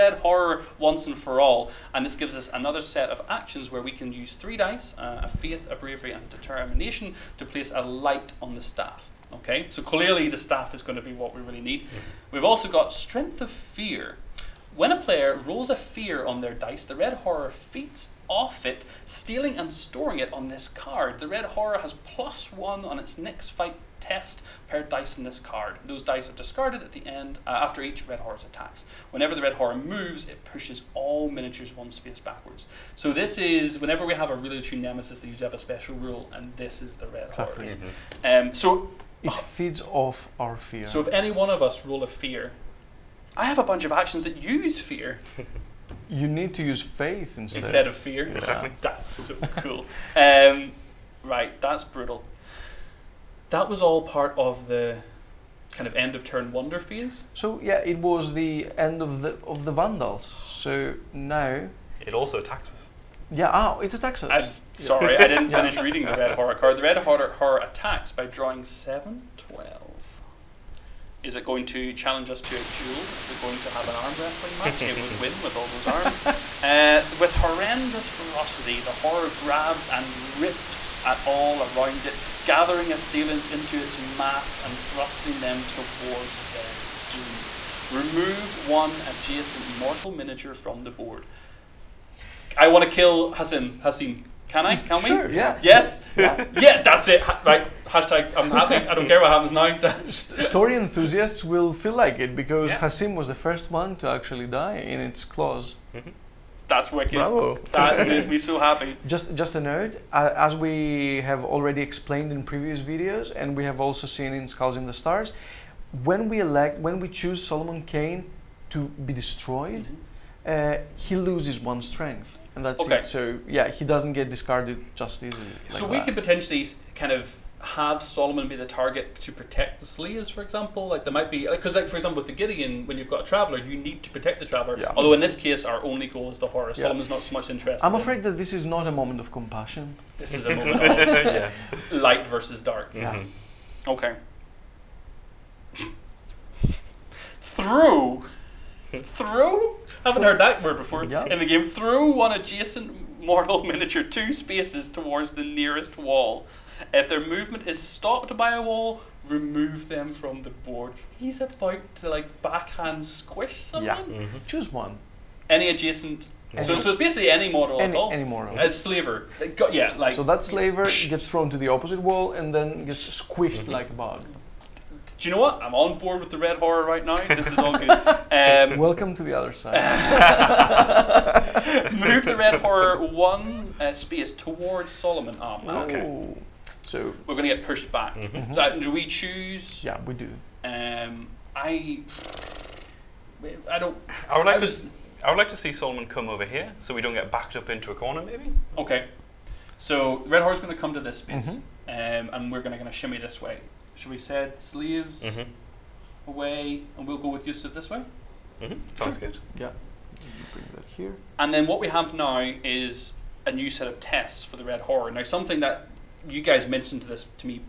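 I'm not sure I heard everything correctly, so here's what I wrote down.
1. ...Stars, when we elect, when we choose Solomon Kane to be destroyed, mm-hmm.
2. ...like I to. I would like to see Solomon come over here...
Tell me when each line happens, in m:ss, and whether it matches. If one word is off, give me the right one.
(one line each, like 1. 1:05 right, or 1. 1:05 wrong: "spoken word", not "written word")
1. 1:54 right
2. 3:14 right.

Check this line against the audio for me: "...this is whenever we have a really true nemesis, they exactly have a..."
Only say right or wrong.
wrong.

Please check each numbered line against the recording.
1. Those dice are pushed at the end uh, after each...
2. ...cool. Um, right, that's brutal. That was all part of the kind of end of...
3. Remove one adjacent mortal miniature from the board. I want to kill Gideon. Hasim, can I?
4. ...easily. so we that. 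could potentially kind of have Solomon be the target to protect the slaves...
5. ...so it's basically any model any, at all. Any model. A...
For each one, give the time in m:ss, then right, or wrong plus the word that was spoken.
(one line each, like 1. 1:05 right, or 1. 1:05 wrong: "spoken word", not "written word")
1. 0:25 wrong: "discarded", not "pushed"
2. 0:49 right
3. 1:27 wrong: "Hasim", not "Gideon"
4. 2:05 right
5. 2:46 right.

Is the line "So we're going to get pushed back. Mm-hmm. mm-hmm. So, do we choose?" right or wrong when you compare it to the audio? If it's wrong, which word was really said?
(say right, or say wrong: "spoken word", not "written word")
right.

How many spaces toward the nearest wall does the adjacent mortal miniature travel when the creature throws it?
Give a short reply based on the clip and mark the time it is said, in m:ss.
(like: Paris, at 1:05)
2, at 2:34.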